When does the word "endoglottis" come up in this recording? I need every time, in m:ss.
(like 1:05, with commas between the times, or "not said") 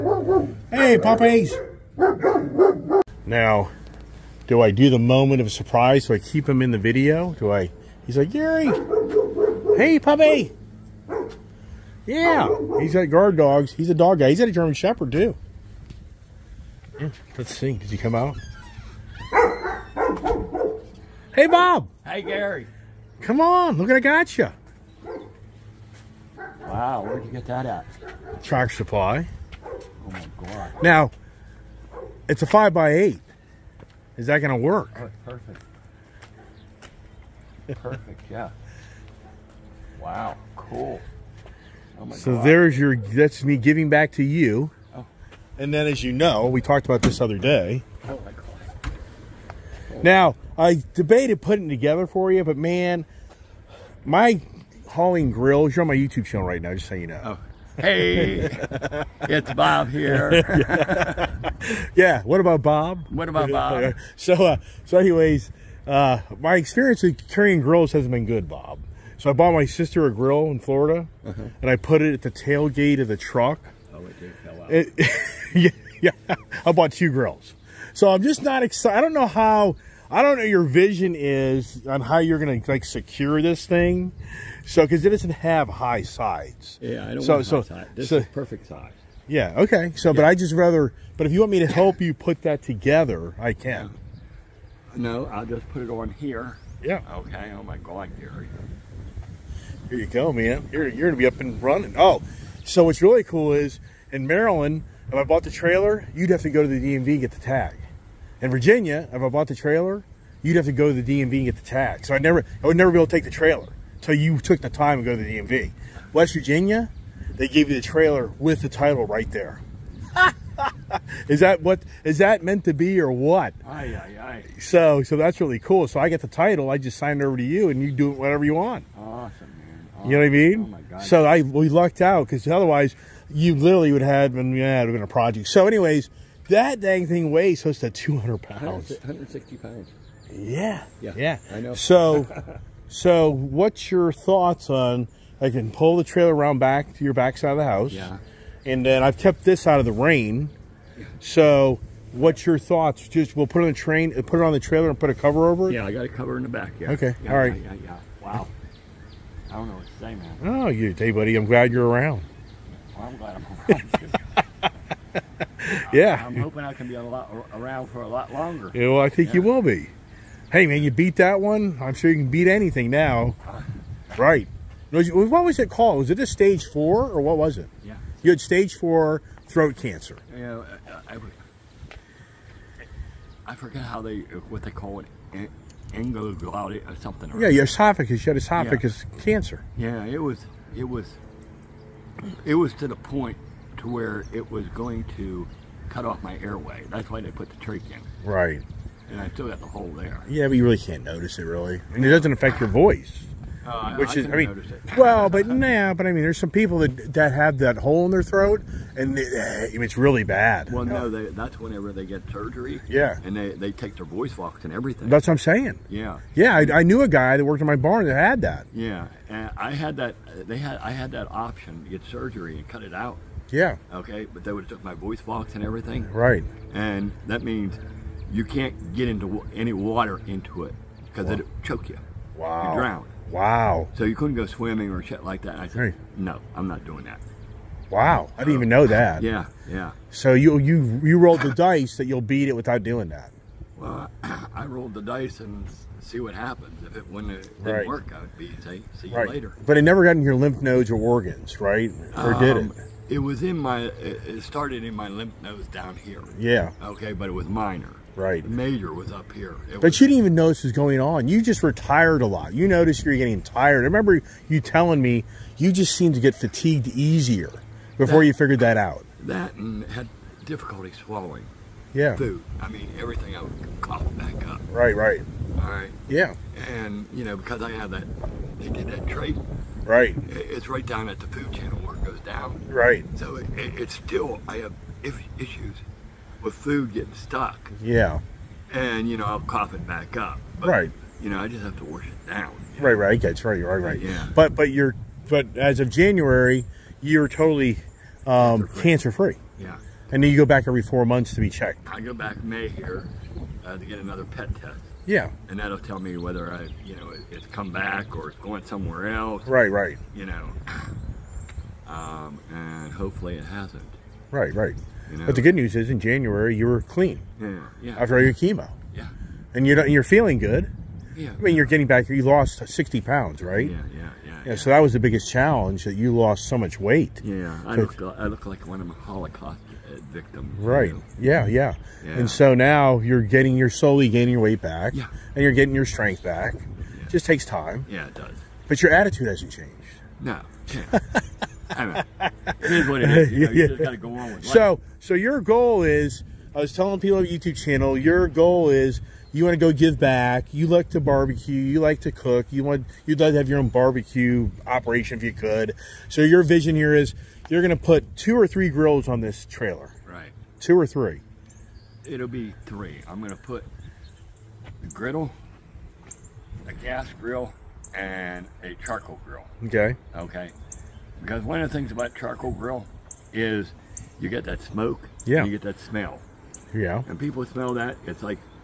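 3:05.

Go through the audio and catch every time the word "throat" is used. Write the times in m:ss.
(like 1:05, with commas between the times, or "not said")
2:59, 3:28.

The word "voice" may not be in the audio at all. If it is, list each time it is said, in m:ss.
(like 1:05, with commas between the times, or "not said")
3:22, 3:34, 3:44.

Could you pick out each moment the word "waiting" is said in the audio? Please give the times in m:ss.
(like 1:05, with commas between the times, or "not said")
not said.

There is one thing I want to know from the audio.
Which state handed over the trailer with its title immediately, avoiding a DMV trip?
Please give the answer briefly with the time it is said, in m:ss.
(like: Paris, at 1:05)
West Virginia, at 1:56.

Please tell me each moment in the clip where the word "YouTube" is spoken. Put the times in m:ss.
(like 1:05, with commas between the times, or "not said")
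0:55, 5:47.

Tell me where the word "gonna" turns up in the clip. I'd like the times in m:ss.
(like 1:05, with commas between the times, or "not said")
1:22, 1:41.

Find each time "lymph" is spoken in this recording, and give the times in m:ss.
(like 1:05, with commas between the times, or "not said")
4:10, 4:15.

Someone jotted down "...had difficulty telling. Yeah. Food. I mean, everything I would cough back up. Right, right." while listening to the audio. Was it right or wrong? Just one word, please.
wrong.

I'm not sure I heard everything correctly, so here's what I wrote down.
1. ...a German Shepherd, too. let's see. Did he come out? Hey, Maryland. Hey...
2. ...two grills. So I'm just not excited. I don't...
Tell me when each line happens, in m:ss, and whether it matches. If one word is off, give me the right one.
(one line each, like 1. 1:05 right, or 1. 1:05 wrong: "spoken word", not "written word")
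1. 0:14 wrong: "Bob", not "Maryland"
2. 1:16 right.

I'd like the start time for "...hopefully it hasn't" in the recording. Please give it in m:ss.
5:12.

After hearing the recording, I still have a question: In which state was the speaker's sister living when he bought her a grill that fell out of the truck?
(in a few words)
Florida.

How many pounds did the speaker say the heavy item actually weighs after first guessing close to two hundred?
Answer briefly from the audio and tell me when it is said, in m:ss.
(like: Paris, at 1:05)
160, at 2:18.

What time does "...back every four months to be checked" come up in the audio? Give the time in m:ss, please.
5:00.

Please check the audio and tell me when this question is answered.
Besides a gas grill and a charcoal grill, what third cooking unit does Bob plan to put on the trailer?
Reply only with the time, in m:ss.
6:04.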